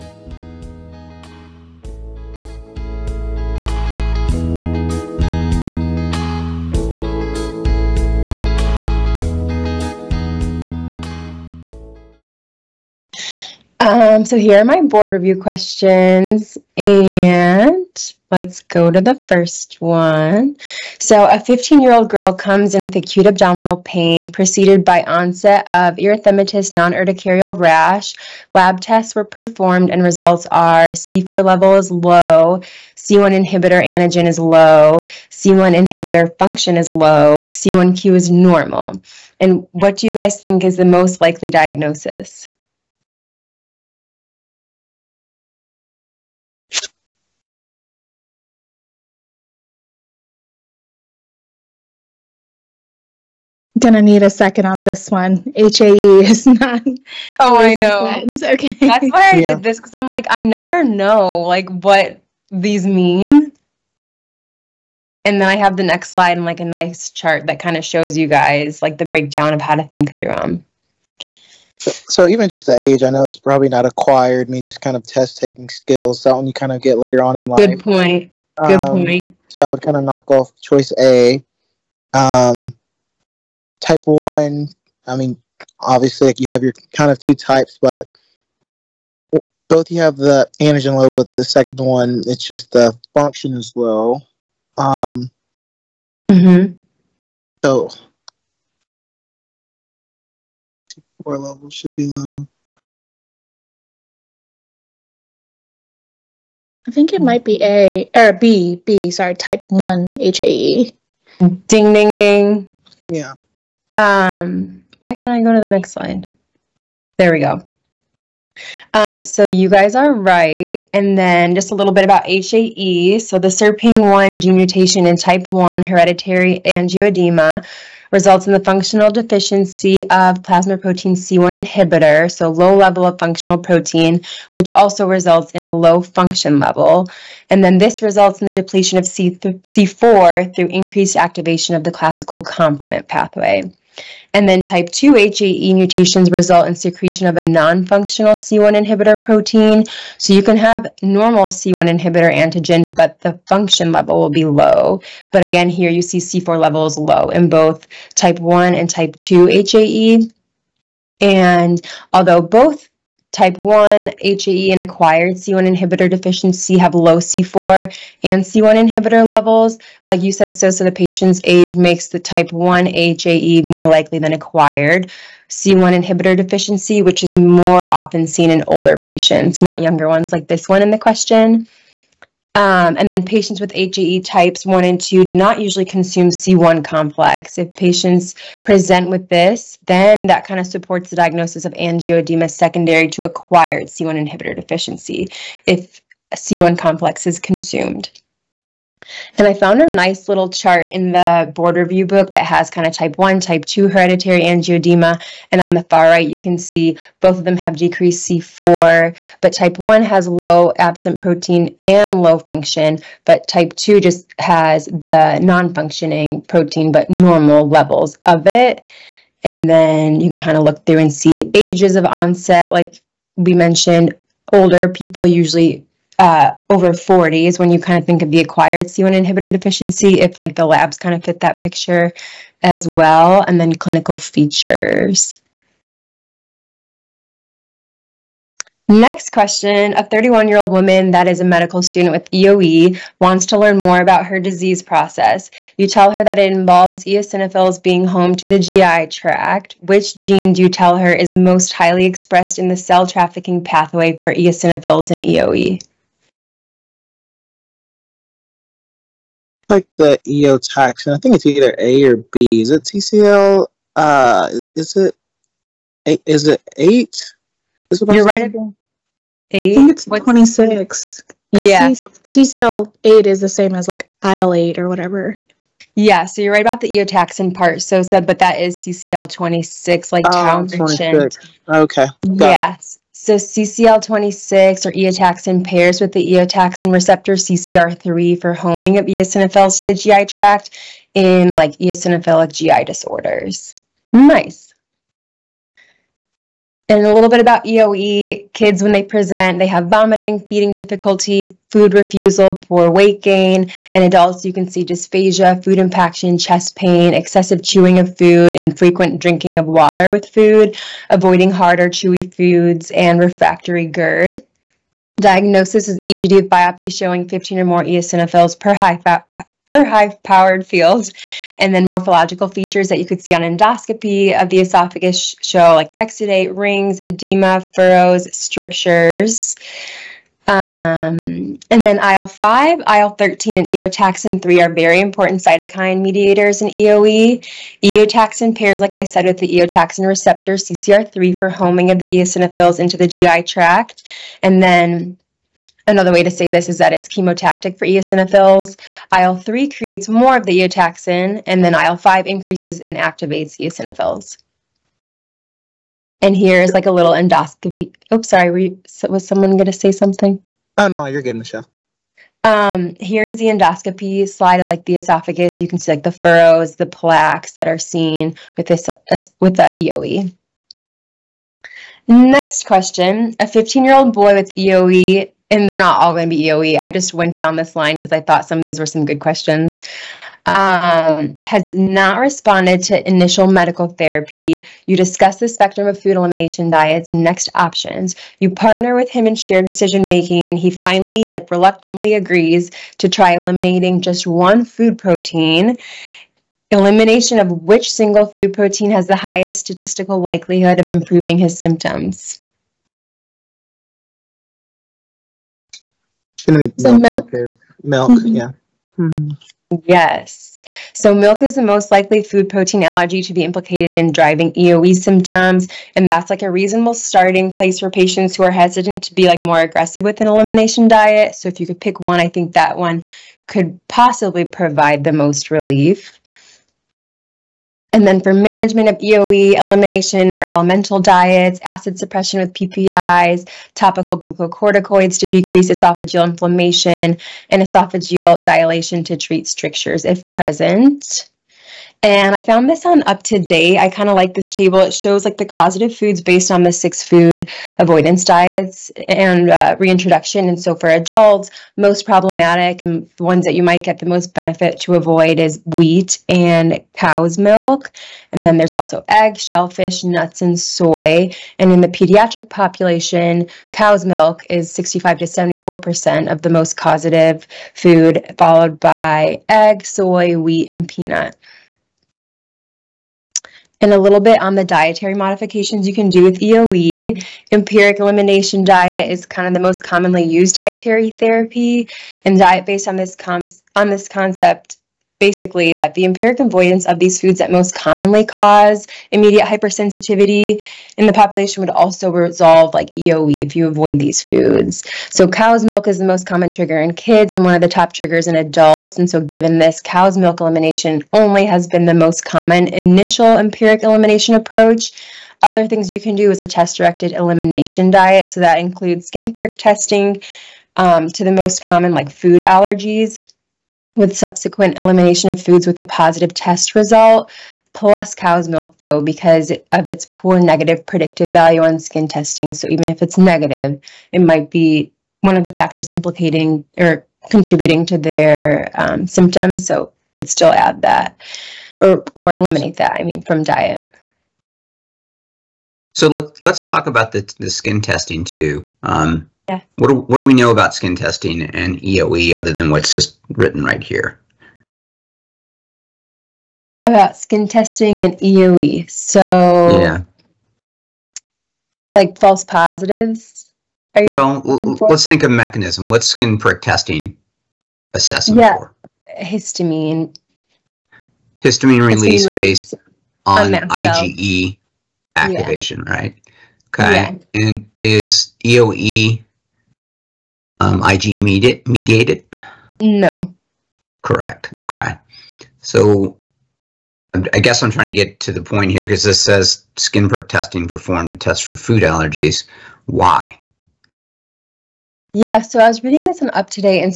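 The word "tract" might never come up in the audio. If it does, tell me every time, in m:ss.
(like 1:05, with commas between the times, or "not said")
4:09, 4:50, 5:43.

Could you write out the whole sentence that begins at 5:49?
IL 3 creates more of the eotaxin, and then IL 5 increases and activates eosinophils.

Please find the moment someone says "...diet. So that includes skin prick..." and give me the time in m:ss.
8:27.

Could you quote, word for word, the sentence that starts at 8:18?
And so given this, cow's milk elimination only has been the most common initial empiric elimination approach.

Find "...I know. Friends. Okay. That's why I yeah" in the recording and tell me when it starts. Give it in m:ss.
0:57.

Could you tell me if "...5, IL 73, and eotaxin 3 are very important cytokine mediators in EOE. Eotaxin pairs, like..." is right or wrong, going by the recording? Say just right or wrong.
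wrong.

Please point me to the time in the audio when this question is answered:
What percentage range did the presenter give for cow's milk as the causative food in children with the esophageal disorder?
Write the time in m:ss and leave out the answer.
7:44.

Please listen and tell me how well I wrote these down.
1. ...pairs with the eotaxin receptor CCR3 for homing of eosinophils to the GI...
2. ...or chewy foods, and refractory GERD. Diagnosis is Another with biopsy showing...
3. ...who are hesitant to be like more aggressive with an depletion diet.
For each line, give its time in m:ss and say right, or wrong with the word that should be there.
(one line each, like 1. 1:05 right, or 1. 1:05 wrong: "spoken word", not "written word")
1. 4:45 right
2. 5:11 wrong: "EGD", not "Another"
3. 6:58 wrong: "elimination", not "depletion".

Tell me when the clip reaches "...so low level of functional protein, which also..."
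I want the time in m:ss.
2:12.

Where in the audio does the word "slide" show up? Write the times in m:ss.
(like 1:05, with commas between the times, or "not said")
1:06, 1:55, 6:04.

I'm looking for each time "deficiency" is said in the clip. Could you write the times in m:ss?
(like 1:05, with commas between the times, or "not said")
2:09, 2:46, 2:56, 3:14, 3:49.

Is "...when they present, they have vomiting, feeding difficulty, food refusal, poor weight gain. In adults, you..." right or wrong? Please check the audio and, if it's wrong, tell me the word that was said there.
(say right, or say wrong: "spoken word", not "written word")
right.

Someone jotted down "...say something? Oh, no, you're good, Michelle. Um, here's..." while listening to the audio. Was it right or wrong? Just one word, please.
right.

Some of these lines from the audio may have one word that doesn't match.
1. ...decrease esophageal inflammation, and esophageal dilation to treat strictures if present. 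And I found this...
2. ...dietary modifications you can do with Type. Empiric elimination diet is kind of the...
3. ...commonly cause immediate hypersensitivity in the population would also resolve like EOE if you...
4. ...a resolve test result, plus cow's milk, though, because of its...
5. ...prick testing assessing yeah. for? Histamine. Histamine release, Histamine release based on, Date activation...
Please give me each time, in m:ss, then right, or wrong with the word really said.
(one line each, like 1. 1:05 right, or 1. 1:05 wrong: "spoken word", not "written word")
1. 7:15 right
2. 7:54 wrong: "EOE", not "Type"
3. 8:07 right
4. 8:35 wrong: "positive", not "resolve"
5. 9:16 wrong: "IgE", not "Date".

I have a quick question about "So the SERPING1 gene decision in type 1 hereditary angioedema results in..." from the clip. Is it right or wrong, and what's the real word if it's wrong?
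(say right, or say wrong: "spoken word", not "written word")
wrong: "mutation", not "decision".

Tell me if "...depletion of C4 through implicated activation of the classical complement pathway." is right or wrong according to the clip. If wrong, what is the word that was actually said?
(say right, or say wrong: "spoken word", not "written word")
wrong: "increased", not "implicated".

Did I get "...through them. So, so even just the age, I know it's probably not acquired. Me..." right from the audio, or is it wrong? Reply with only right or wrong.
right.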